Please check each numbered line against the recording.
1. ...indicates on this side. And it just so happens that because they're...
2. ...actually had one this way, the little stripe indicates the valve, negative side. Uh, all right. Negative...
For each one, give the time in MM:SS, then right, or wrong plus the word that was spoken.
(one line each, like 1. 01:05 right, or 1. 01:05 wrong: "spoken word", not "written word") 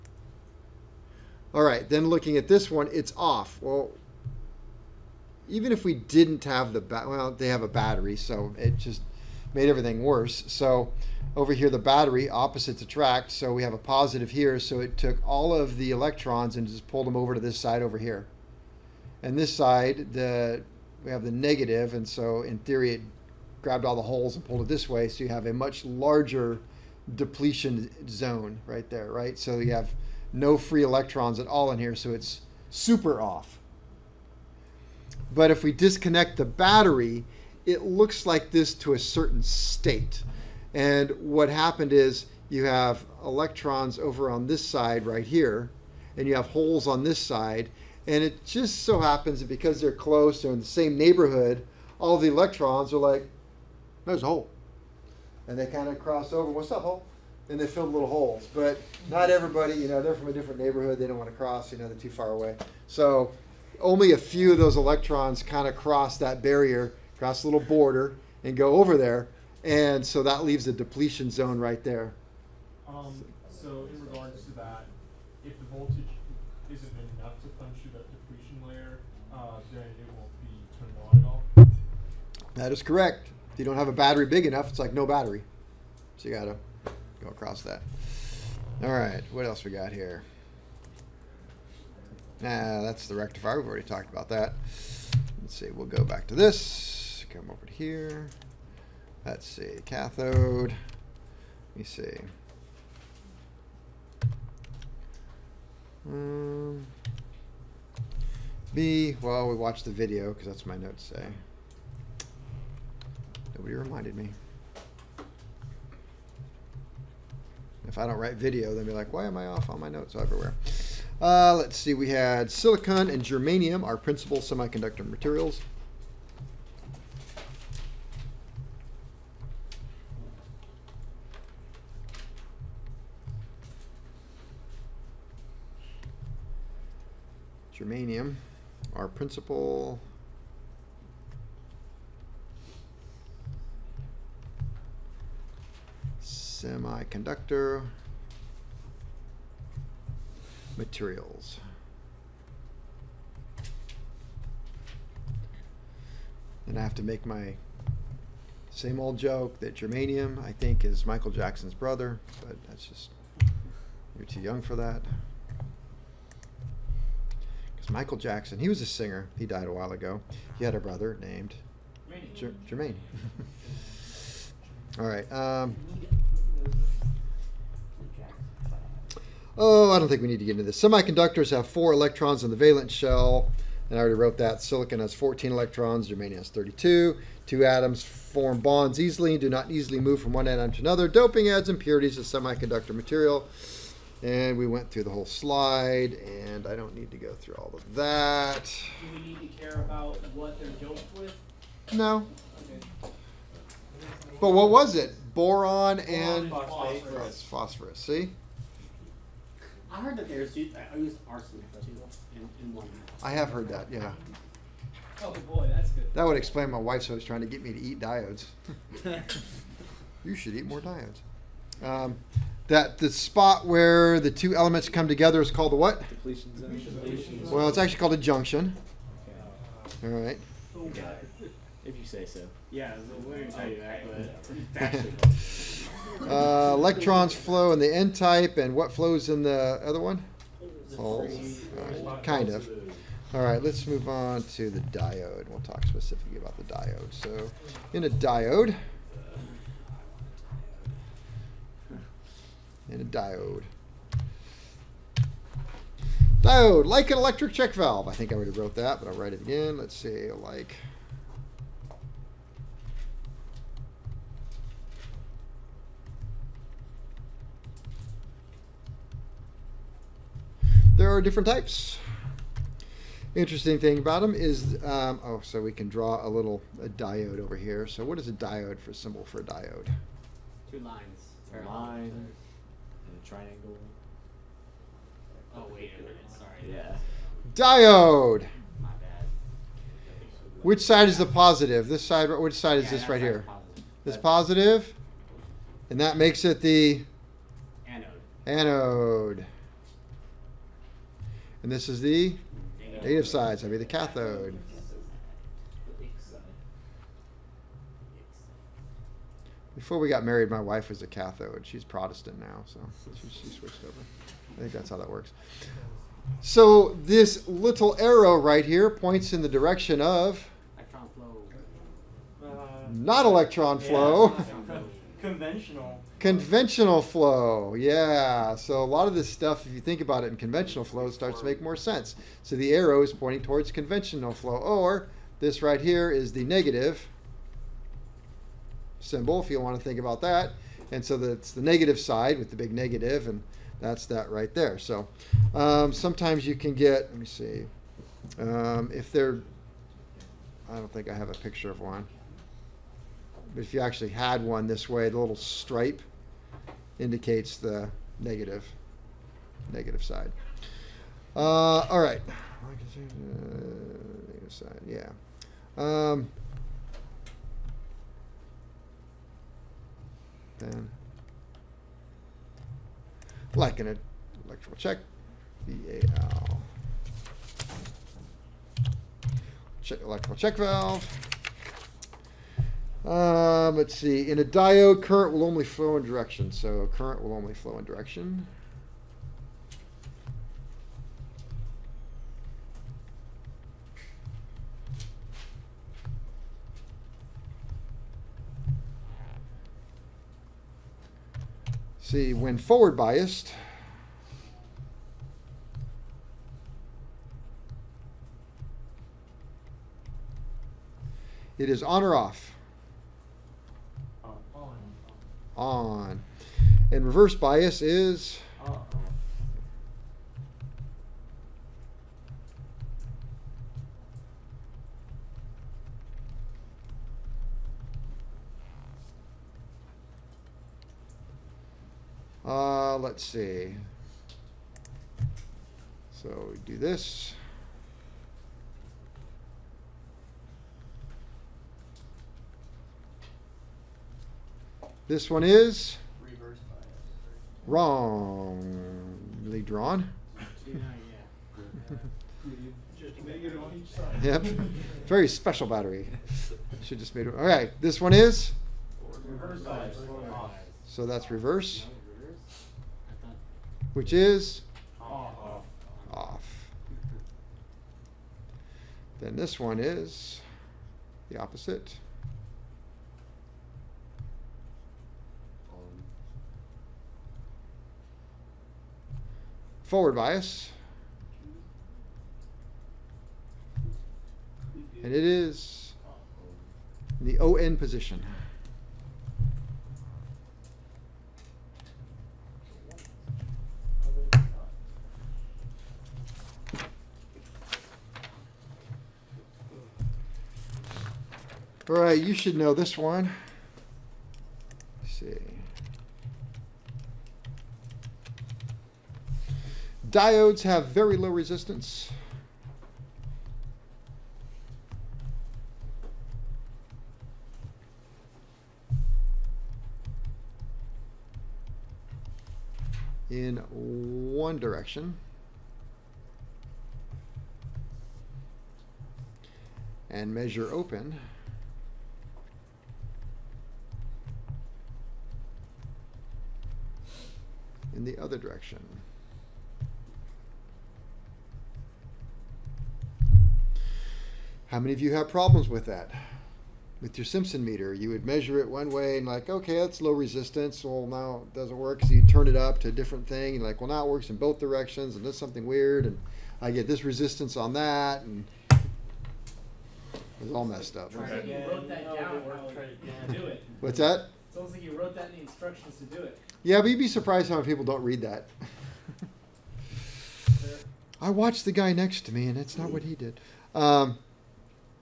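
1. 00:46 wrong: "holes", not "indicates"
2. 05:53 wrong: "negative", not "valve".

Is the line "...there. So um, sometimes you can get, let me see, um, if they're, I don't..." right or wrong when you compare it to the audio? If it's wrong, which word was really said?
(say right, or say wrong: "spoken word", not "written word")
right.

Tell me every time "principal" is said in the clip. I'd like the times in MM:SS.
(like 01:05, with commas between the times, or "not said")
02:03, 02:19.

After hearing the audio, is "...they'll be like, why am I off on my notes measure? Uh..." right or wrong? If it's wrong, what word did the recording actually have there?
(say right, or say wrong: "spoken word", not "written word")
wrong: "everywhere", not "measure".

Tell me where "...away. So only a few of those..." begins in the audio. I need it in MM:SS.
01:02.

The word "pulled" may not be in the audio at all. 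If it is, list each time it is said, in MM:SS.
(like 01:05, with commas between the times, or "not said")
00:16, 00:24.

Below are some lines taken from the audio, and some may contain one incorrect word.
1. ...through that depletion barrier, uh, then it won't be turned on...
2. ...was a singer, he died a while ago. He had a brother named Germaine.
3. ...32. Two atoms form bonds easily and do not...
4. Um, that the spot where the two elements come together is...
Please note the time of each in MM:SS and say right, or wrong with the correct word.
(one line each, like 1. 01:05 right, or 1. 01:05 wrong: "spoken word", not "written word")
1. 01:17 wrong: "layer", not "barrier"
2. 02:48 right
3. 03:06 right
4. 03:41 right.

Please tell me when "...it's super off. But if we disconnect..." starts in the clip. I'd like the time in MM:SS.
00:32.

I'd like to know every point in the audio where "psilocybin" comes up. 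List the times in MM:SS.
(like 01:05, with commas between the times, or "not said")
not said.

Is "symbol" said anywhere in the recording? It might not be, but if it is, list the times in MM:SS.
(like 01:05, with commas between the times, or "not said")
04:38, 05:38.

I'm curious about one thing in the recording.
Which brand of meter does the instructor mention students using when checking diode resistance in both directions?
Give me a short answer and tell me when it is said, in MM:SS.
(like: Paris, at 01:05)
Simpson, at 09:07.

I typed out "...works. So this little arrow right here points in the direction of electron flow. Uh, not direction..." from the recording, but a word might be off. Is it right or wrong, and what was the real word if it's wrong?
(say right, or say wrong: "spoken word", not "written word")
wrong: "electron", not "direction".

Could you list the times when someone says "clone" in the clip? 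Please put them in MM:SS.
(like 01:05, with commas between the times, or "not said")
not said.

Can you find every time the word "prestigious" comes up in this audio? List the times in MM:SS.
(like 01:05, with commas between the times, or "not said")
not said.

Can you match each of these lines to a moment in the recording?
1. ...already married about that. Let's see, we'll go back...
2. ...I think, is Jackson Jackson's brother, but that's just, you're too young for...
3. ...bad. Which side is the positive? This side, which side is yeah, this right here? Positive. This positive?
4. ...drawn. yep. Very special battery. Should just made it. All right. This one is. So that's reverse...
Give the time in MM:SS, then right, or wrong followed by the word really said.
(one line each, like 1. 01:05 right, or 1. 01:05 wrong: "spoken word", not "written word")
1. 01:33 wrong: "talked", not "married"
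2. 02:40 wrong: "Michael", not "Jackson"
3. 04:48 right
4. 07:29 right.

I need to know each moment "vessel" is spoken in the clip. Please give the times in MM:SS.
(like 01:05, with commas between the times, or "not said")
not said.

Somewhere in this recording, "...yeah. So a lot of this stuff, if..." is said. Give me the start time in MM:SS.
05:27.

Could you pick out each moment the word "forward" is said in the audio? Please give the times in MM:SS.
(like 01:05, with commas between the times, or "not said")
06:42, 07:59.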